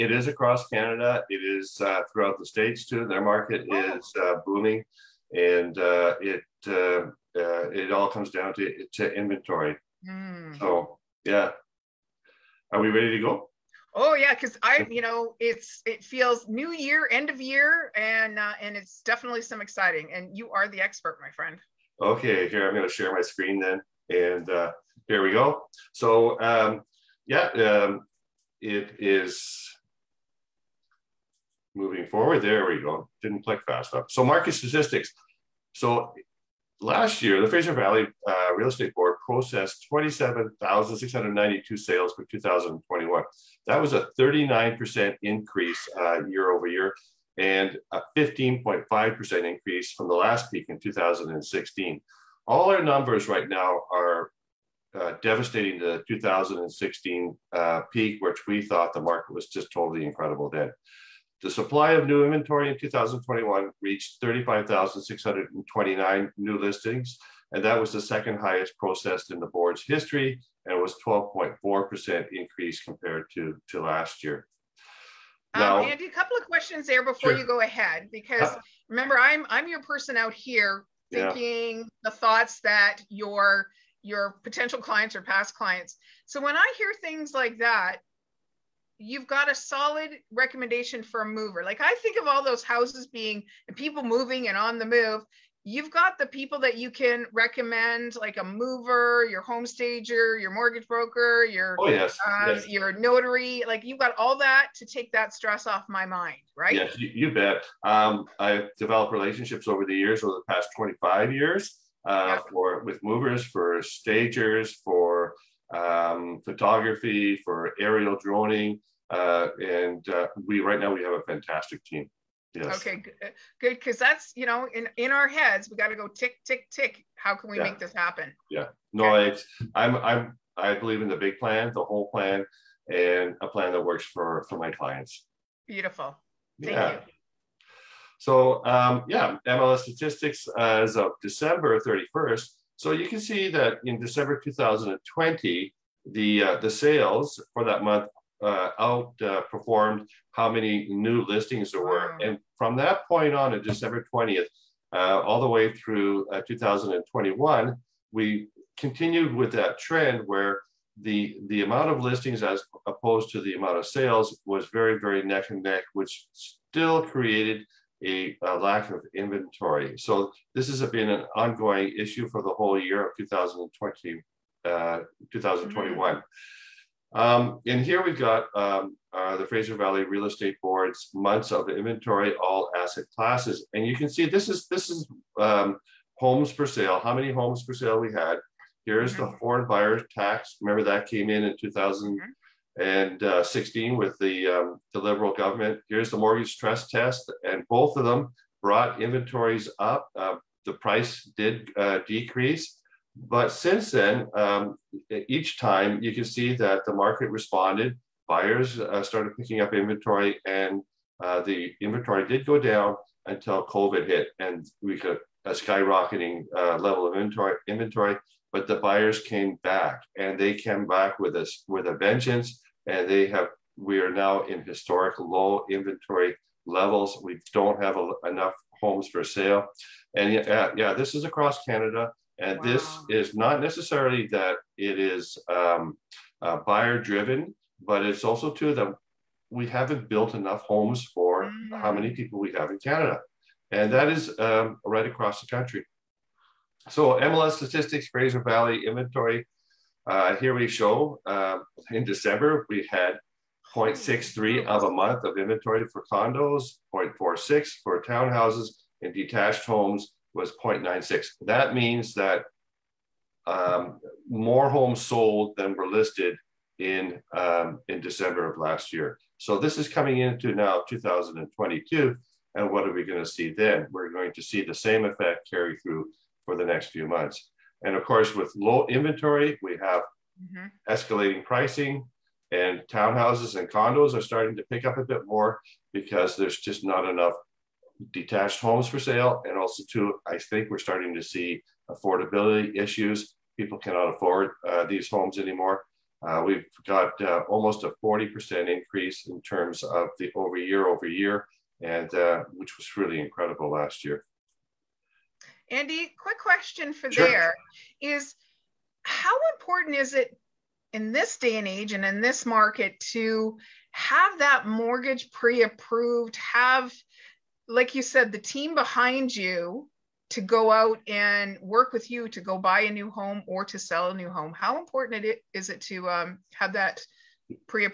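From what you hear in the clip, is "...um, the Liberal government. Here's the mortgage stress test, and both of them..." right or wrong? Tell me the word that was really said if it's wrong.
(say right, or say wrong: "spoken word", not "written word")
right.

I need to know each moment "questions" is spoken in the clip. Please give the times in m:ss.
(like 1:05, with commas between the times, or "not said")
1:16, 5:06.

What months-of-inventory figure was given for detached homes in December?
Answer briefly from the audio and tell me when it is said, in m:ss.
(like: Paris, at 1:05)
0.96, at 4:20.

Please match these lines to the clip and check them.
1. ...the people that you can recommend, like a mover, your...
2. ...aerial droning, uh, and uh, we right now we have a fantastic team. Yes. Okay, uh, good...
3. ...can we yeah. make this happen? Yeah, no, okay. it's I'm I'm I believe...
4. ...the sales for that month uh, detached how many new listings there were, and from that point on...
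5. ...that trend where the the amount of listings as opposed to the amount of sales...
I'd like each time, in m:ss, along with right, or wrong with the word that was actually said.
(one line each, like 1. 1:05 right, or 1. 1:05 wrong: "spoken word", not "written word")
1. 1:36 right
2. 1:57 right
3. 2:07 right
4. 2:26 wrong: "outperformed", not "detached"
5. 2:39 right.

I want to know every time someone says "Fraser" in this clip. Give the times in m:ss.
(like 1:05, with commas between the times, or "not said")
0:37, 2:59, 4:08.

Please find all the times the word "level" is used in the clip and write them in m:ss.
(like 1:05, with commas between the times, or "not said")
3:36, 3:46.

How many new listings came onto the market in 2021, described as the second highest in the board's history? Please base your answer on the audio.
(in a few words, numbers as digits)
35,629.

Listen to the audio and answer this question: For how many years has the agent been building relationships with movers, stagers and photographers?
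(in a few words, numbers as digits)
25 years.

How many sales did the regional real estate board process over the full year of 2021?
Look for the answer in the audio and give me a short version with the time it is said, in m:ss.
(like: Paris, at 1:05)
27,692, at 0:39.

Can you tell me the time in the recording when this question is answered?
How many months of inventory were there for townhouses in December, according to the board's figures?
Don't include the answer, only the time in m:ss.
4:16.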